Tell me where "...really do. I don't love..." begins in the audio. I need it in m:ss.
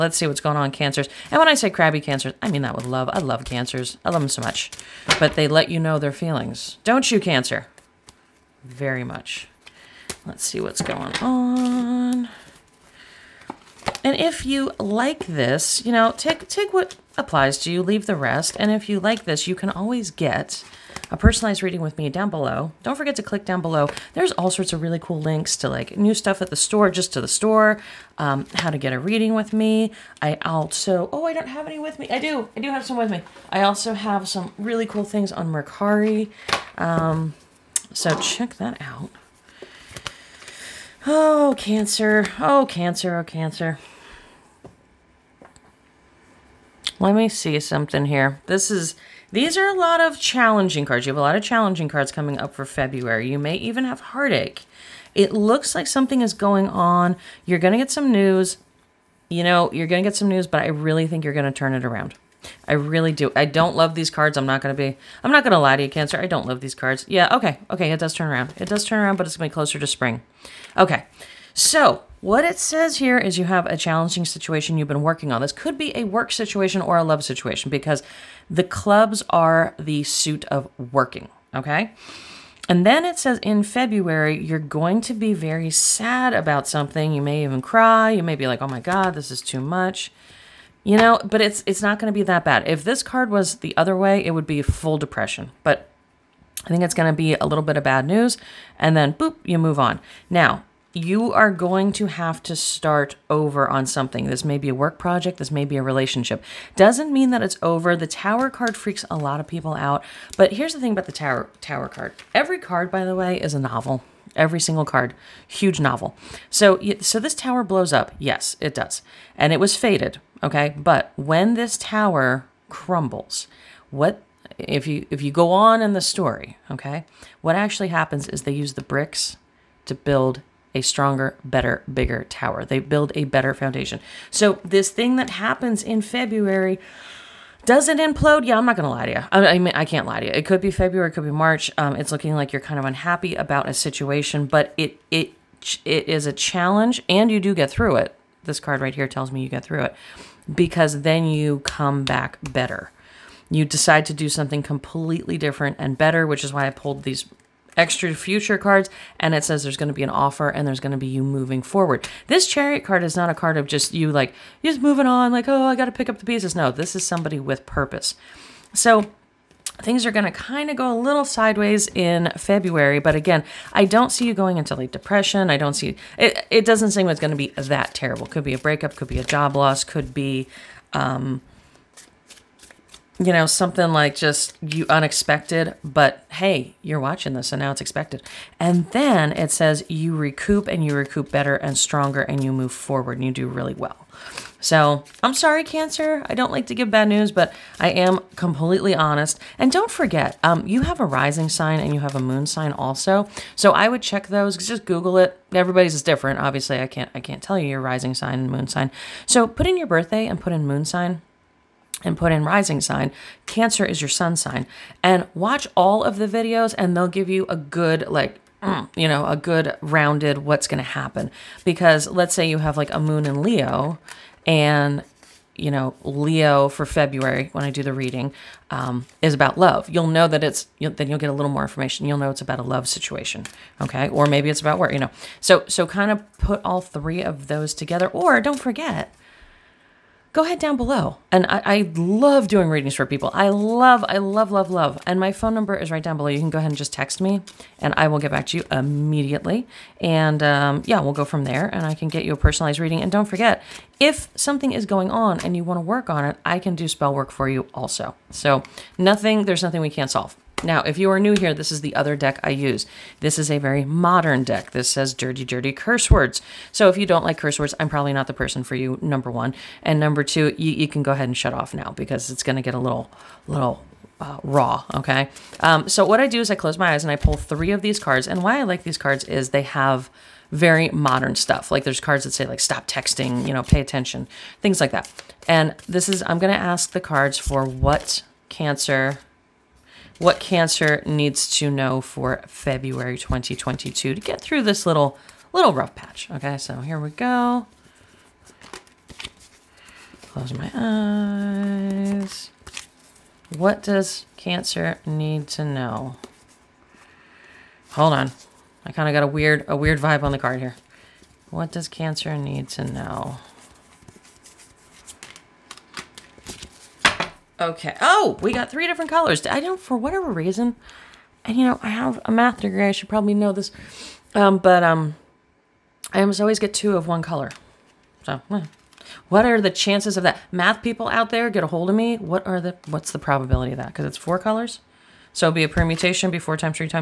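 1:02.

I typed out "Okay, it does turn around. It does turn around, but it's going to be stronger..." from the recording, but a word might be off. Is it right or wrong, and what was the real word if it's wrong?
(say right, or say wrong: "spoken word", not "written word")
wrong: "closer", not "stronger".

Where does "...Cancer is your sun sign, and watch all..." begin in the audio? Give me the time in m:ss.
3:33.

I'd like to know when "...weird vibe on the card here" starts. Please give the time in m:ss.
5:09.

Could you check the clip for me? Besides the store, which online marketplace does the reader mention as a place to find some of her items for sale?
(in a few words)
Mercari.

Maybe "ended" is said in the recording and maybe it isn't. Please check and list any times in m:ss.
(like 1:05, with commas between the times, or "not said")
not said.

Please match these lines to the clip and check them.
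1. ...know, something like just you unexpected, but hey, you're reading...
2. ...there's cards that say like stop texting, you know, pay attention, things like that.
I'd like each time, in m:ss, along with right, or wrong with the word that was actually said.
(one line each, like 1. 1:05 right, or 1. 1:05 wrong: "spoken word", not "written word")
1. 3:03 wrong: "watching", not "reading"
2. 4:41 right.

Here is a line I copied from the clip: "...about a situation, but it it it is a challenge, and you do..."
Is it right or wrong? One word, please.
right.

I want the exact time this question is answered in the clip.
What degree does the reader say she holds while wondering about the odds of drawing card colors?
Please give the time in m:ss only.
5:22.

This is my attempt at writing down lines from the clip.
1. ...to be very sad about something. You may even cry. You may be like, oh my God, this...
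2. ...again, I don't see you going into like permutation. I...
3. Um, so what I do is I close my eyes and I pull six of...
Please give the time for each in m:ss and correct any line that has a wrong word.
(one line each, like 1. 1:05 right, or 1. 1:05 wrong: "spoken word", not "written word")
1. 1:25 right
2. 2:53 wrong: "depression", not "permutation"
3. 4:35 wrong: "three", not "six".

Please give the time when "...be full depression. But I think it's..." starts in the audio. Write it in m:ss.
1:34.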